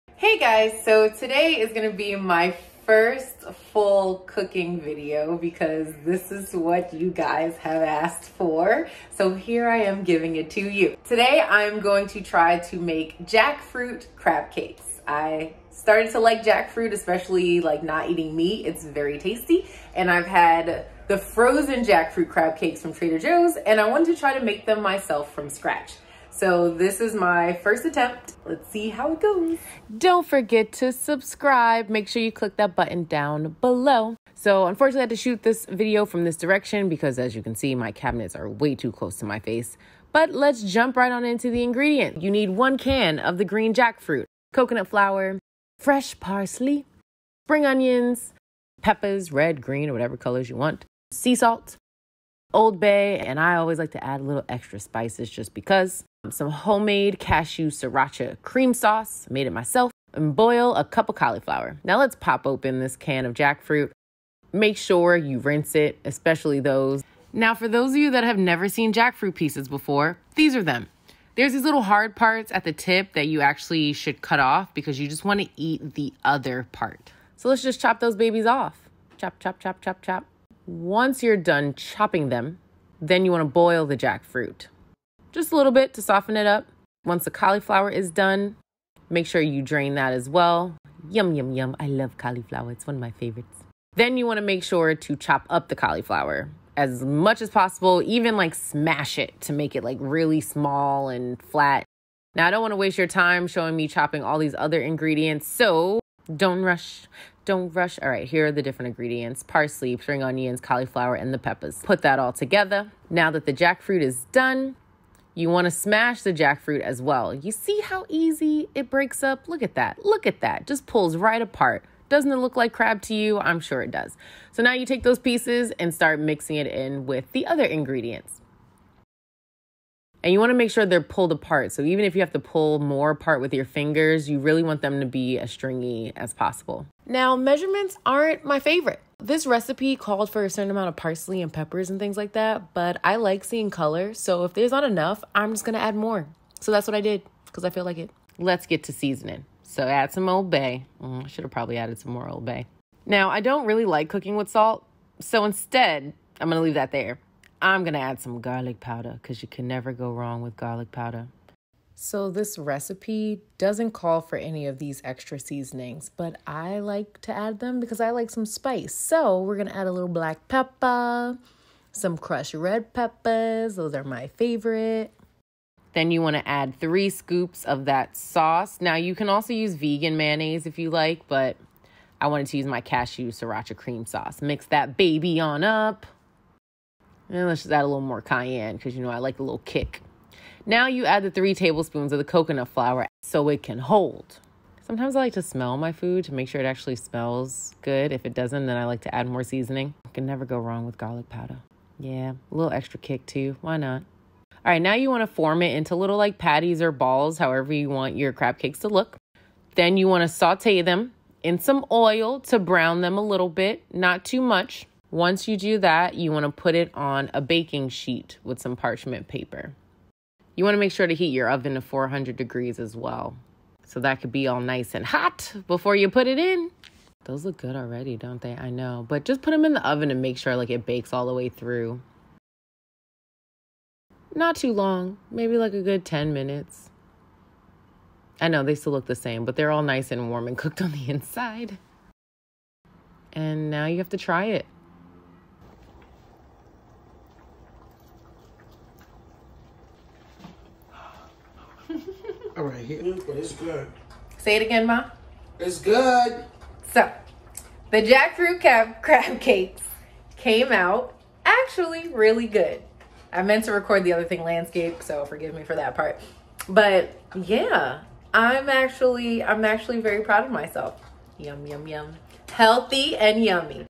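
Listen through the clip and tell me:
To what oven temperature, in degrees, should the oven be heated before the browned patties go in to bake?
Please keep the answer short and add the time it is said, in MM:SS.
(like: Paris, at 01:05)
400, at 03:41.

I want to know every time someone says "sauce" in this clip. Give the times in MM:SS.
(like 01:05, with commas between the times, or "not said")
00:58, 02:58, 03:04.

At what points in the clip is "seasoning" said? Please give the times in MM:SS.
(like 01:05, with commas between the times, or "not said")
02:28, 02:45, 03:19.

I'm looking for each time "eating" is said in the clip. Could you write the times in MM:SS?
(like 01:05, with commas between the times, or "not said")
00:18.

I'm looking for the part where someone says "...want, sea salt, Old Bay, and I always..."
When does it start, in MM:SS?
00:50.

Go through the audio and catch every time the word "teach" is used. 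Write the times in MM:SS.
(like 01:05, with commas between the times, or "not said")
not said.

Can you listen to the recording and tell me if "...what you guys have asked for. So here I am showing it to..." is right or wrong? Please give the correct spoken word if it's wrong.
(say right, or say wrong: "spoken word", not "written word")
wrong: "giving", not "showing".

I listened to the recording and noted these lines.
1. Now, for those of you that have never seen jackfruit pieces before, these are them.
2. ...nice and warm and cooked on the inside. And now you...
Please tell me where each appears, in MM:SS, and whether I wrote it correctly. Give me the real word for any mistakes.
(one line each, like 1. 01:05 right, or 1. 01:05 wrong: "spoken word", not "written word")
1. 01:07 right
2. 03:59 right.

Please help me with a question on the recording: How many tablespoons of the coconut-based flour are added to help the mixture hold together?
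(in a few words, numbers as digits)
3.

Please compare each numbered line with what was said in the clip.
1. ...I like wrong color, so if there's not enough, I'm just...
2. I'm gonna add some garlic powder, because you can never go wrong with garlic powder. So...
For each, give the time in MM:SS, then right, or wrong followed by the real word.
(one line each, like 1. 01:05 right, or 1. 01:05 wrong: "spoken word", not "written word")
1. 02:23 wrong: "seeing", not "wrong"
2. 02:37 right.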